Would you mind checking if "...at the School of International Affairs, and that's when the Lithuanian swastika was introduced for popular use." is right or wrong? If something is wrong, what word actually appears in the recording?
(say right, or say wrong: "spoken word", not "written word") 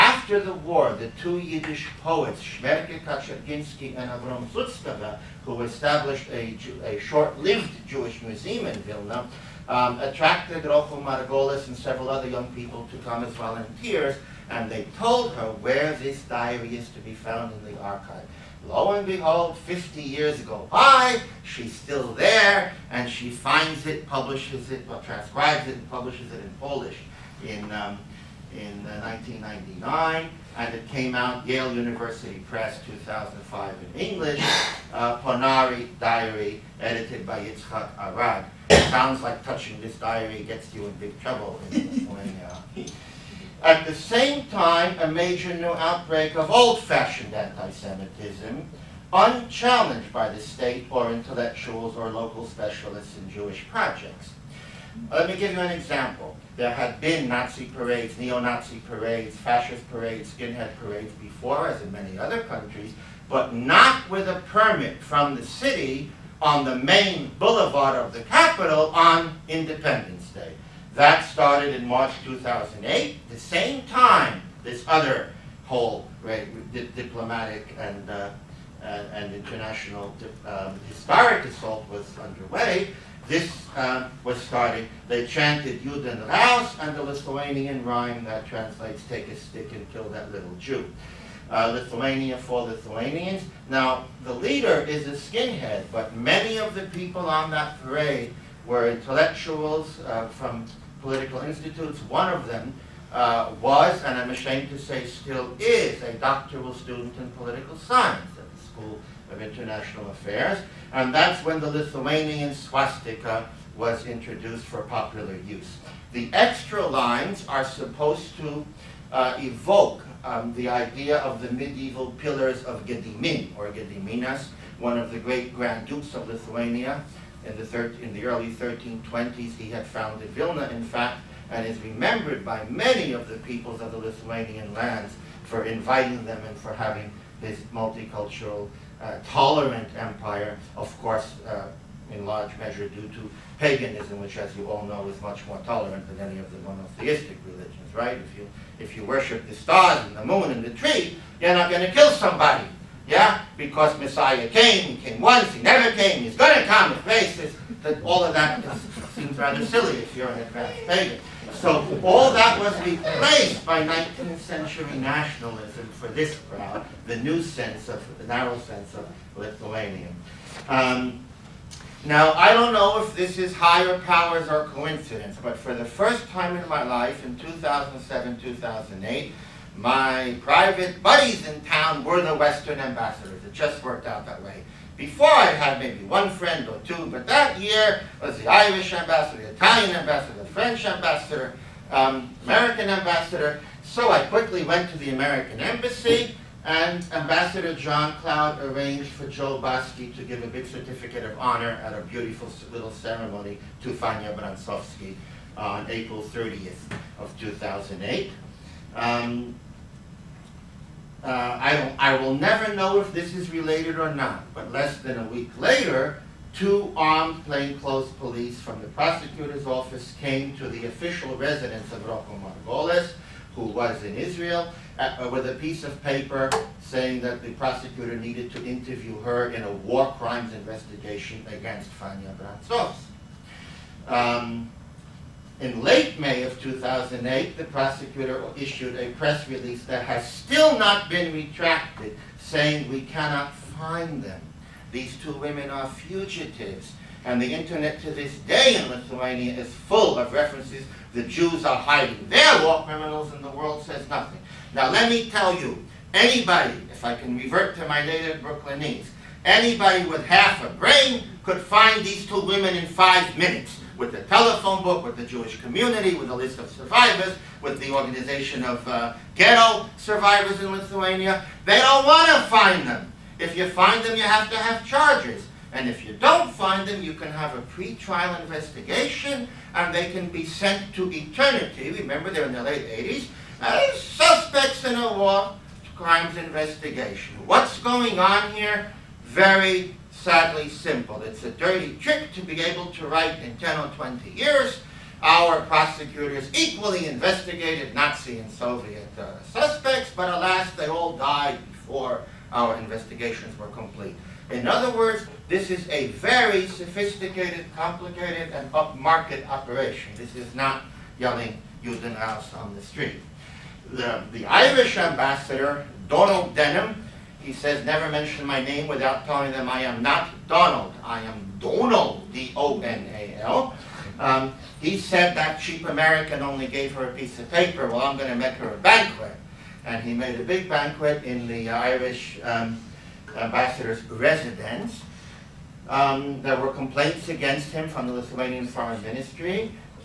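right.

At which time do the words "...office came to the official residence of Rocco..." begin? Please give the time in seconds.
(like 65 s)
219 s.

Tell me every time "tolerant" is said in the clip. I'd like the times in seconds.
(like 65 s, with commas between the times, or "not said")
139 s, 145 s.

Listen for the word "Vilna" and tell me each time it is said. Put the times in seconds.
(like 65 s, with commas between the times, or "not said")
8 s, 130 s.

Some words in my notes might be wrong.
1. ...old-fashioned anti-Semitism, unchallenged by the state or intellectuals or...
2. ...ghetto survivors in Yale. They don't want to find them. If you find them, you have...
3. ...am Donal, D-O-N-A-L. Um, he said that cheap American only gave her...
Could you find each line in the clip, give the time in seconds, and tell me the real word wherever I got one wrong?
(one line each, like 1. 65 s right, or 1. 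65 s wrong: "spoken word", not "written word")
1. 46 s right
2. 269 s wrong: "Lithuania", not "Yale"
3. 321 s right.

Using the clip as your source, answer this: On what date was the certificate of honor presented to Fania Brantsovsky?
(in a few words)
April 30, 2008.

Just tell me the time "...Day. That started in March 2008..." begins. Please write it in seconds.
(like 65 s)
70 s.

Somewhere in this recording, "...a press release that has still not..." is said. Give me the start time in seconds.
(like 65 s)
238 s.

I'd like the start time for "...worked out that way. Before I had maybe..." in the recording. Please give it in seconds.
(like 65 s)
183 s.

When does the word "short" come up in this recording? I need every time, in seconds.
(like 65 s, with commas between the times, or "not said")
6 s.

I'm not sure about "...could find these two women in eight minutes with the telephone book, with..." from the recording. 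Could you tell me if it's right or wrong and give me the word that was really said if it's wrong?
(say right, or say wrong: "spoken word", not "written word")
wrong: "five", not "eight".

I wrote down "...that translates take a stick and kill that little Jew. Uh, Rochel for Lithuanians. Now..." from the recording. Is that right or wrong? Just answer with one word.
wrong.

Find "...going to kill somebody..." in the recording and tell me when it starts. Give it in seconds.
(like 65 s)
151 s.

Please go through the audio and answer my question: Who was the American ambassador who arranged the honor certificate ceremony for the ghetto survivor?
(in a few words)
John Cloud.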